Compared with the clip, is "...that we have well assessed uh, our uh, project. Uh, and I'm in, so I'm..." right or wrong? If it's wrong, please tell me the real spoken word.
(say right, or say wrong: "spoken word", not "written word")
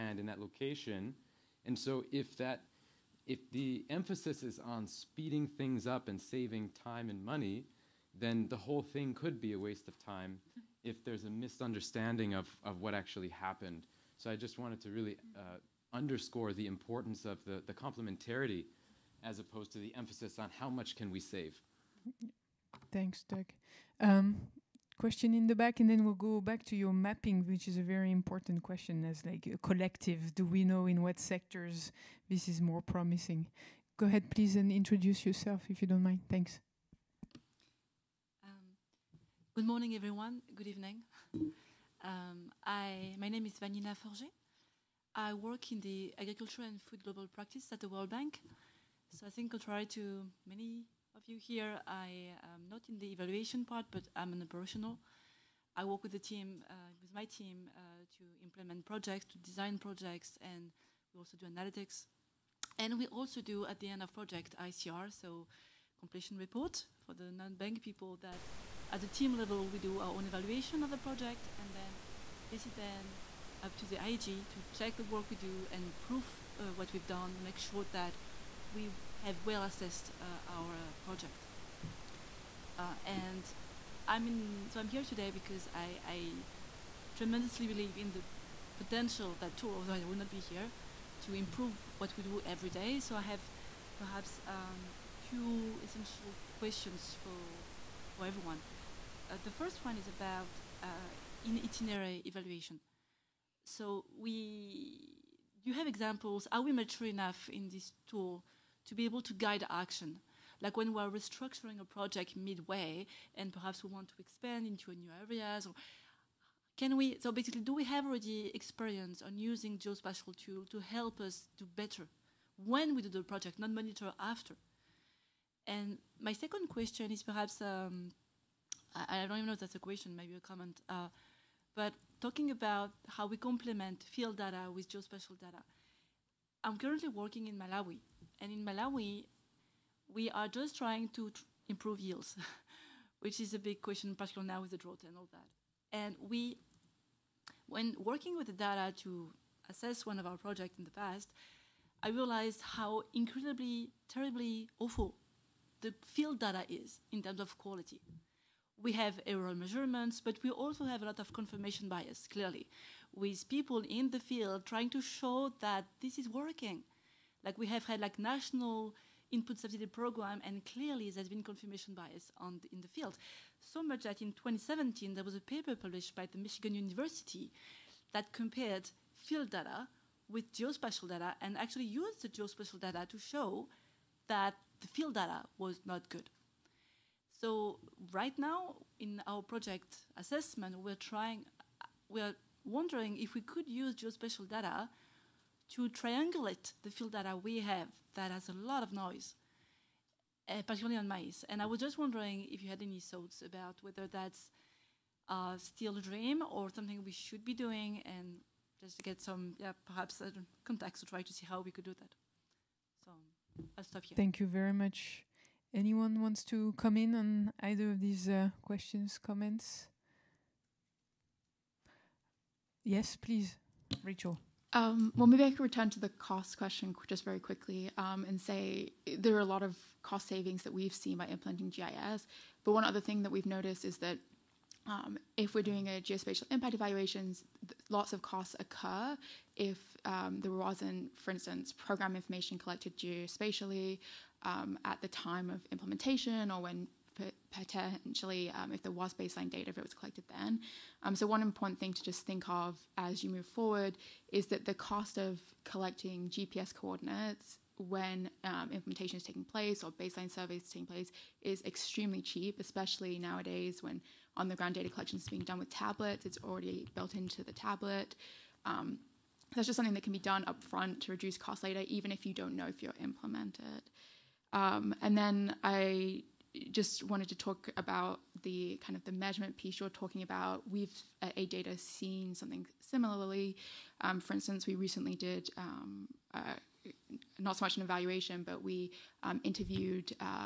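right.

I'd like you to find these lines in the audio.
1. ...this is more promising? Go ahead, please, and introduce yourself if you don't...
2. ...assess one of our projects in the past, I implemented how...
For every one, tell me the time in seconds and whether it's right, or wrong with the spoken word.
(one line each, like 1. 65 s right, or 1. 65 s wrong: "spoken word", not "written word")
1. 32 s right
2. 149 s wrong: "realized", not "implemented".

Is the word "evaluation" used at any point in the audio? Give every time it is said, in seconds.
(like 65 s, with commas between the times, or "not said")
53 s, 70 s, 102 s, 236 s, 287 s.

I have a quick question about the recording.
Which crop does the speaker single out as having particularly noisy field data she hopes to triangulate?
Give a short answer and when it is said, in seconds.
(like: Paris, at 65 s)
Maize, at 201 s.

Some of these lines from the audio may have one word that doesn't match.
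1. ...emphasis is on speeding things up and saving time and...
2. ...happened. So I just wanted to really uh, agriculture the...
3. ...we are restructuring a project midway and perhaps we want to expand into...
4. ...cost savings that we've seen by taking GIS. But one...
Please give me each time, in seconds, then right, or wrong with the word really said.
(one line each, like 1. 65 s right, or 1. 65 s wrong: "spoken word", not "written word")
1. 3 s right
2. 13 s wrong: "underscore", not "agriculture"
3. 110 s right
4. 230 s wrong: "implementing", not "taking".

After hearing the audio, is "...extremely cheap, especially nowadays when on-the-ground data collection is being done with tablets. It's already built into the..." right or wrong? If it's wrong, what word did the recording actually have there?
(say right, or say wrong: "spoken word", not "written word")
right.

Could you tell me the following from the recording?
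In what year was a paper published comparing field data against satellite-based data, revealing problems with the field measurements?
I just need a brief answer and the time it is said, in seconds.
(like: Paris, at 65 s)
2017, at 174 s.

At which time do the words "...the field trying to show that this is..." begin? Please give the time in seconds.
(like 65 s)
164 s.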